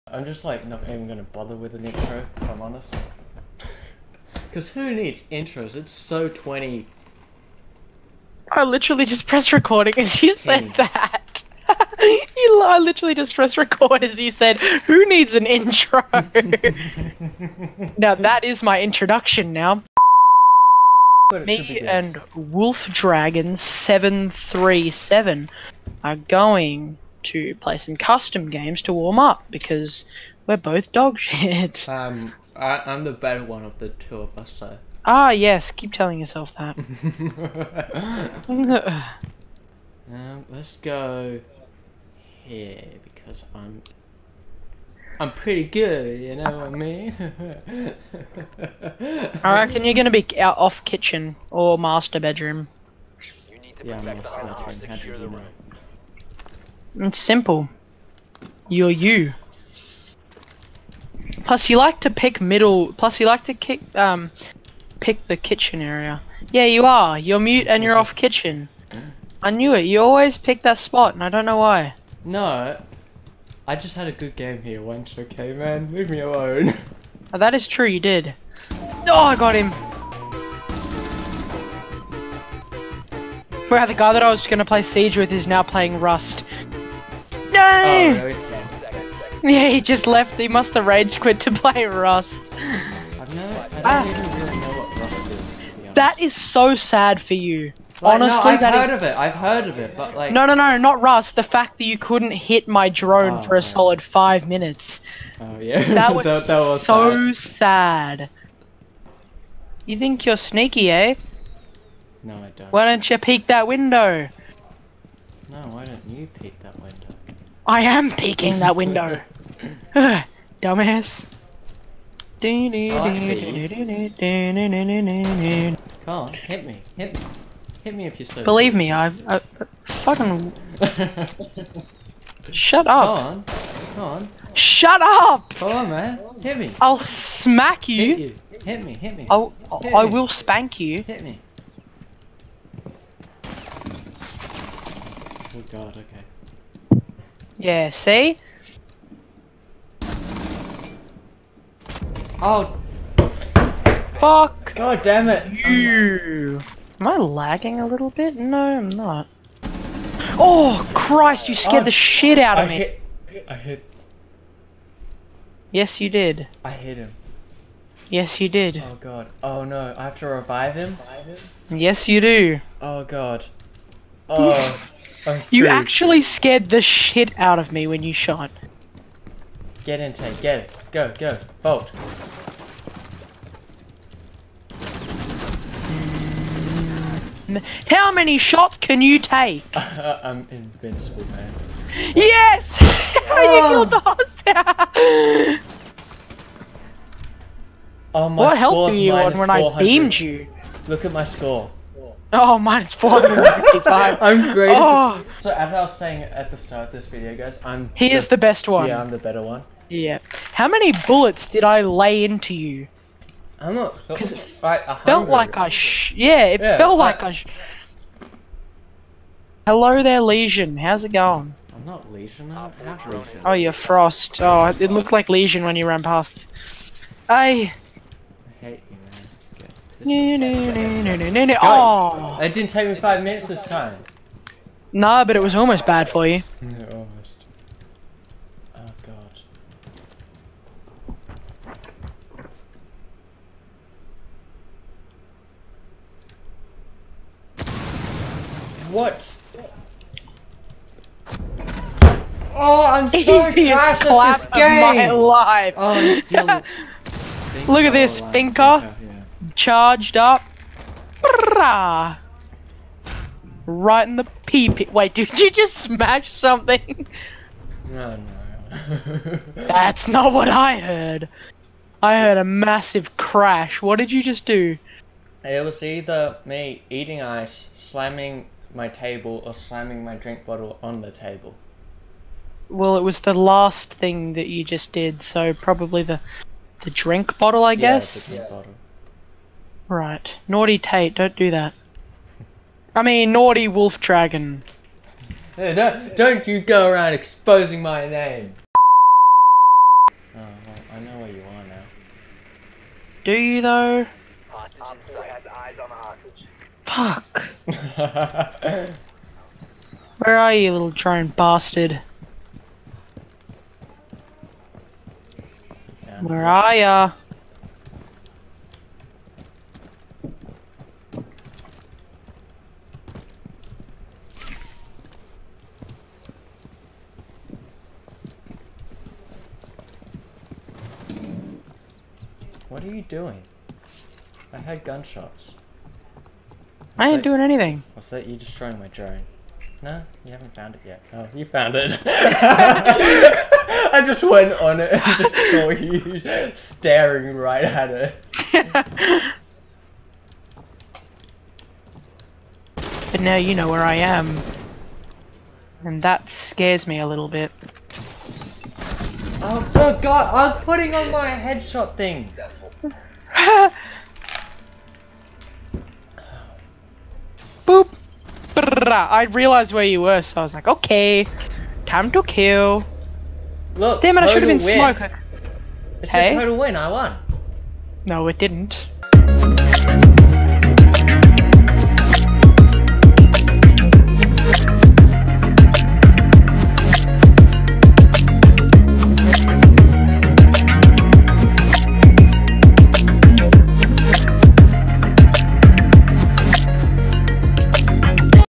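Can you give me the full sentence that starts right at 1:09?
You always pick that spot, and I don't know why.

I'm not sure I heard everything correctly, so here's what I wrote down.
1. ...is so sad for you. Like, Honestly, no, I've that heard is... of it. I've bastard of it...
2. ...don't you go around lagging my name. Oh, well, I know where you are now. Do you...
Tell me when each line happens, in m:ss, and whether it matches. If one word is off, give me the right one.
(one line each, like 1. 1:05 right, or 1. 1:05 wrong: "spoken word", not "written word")
1. 1:36 wrong: "heard", not "bastard"
2. 4:56 wrong: "exposing", not "lagging".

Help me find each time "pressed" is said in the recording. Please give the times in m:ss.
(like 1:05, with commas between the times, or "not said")
0:09, 0:13.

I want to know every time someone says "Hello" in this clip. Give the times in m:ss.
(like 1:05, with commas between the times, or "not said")
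3:39.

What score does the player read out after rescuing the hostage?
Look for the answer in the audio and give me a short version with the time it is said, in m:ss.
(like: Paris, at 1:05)
-455, at 3:22.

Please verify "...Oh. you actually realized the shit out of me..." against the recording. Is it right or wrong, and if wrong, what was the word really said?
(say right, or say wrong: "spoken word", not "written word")
wrong: "scared", not "realized".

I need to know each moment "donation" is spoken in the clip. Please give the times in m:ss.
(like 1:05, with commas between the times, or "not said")
not said.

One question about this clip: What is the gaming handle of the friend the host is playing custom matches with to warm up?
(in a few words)
Wolf Dragon 737.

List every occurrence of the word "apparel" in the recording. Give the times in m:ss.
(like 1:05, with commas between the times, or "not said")
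not said.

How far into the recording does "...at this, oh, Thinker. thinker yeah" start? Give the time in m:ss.
4:17.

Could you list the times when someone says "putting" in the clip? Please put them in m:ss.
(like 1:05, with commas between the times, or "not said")
6:00.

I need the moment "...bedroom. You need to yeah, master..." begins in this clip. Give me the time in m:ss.
0:52.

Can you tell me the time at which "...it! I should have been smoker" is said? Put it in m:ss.
6:14.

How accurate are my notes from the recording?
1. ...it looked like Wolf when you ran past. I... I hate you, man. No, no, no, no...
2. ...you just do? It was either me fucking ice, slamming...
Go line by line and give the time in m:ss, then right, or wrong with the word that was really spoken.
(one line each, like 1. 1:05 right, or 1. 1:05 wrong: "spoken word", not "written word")
1. 3:44 wrong: "Lesion", not "Wolf"
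2. 4:34 wrong: "eating", not "fucking".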